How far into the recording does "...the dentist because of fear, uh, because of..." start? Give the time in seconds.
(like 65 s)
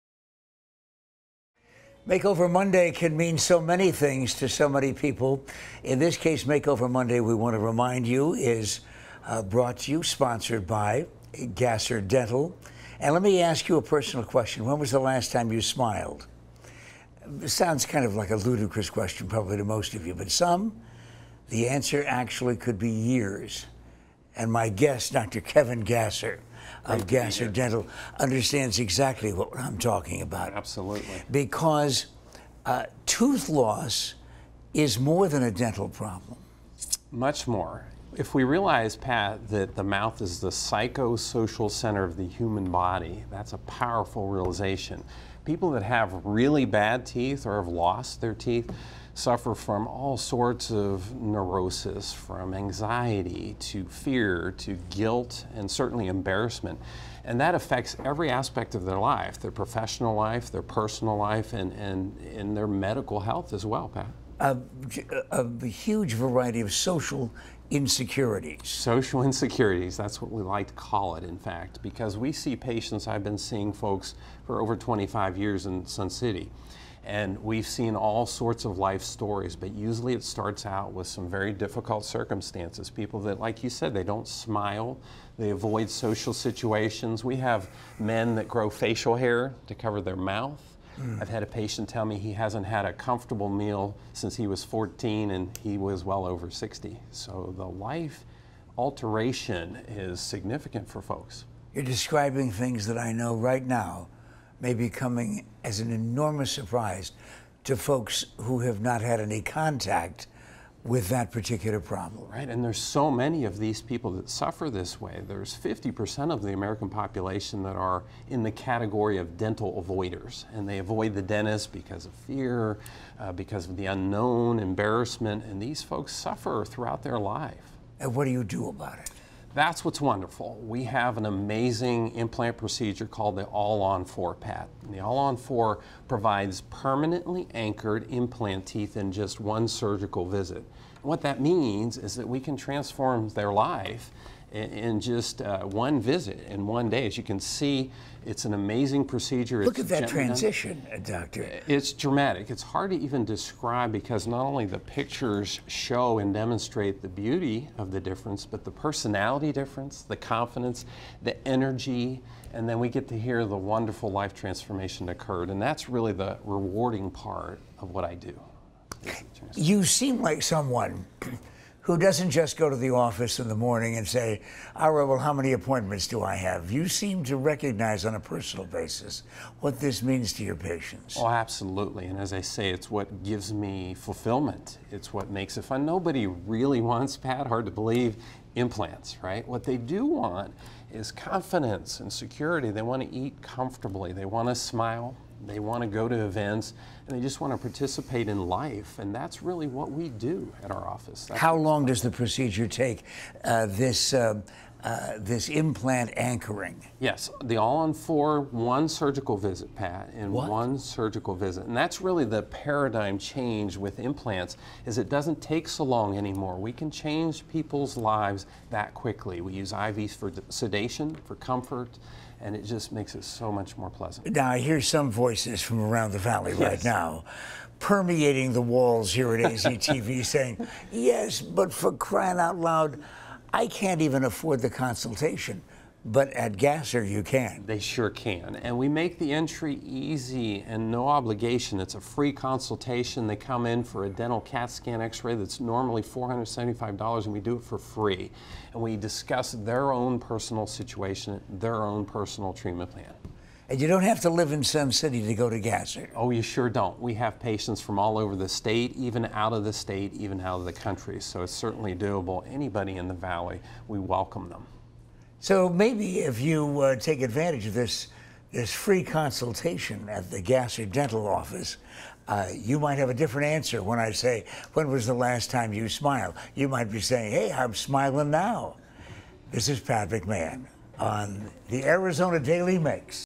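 121 s.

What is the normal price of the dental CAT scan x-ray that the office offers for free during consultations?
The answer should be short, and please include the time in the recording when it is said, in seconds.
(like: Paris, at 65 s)
$475, at 246 s.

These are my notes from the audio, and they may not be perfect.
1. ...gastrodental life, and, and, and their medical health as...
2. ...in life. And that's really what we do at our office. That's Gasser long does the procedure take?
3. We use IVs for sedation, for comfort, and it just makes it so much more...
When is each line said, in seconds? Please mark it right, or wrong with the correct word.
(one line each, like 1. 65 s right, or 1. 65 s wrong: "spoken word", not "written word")
1. 60 s wrong: "personal", not "gastrodental"
2. 198 s wrong: "How", not "Gasser"
3. 219 s right.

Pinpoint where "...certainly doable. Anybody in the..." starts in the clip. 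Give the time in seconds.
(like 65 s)
261 s.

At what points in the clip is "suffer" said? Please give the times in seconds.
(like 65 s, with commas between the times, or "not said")
49 s, 114 s, 126 s.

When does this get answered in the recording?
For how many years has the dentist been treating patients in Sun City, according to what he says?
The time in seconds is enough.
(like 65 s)
74 s.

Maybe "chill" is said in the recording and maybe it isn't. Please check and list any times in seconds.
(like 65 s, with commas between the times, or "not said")
not said.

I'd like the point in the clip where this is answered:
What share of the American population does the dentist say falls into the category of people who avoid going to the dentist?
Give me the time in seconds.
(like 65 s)
115 s.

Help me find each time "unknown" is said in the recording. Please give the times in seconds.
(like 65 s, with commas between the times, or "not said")
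123 s.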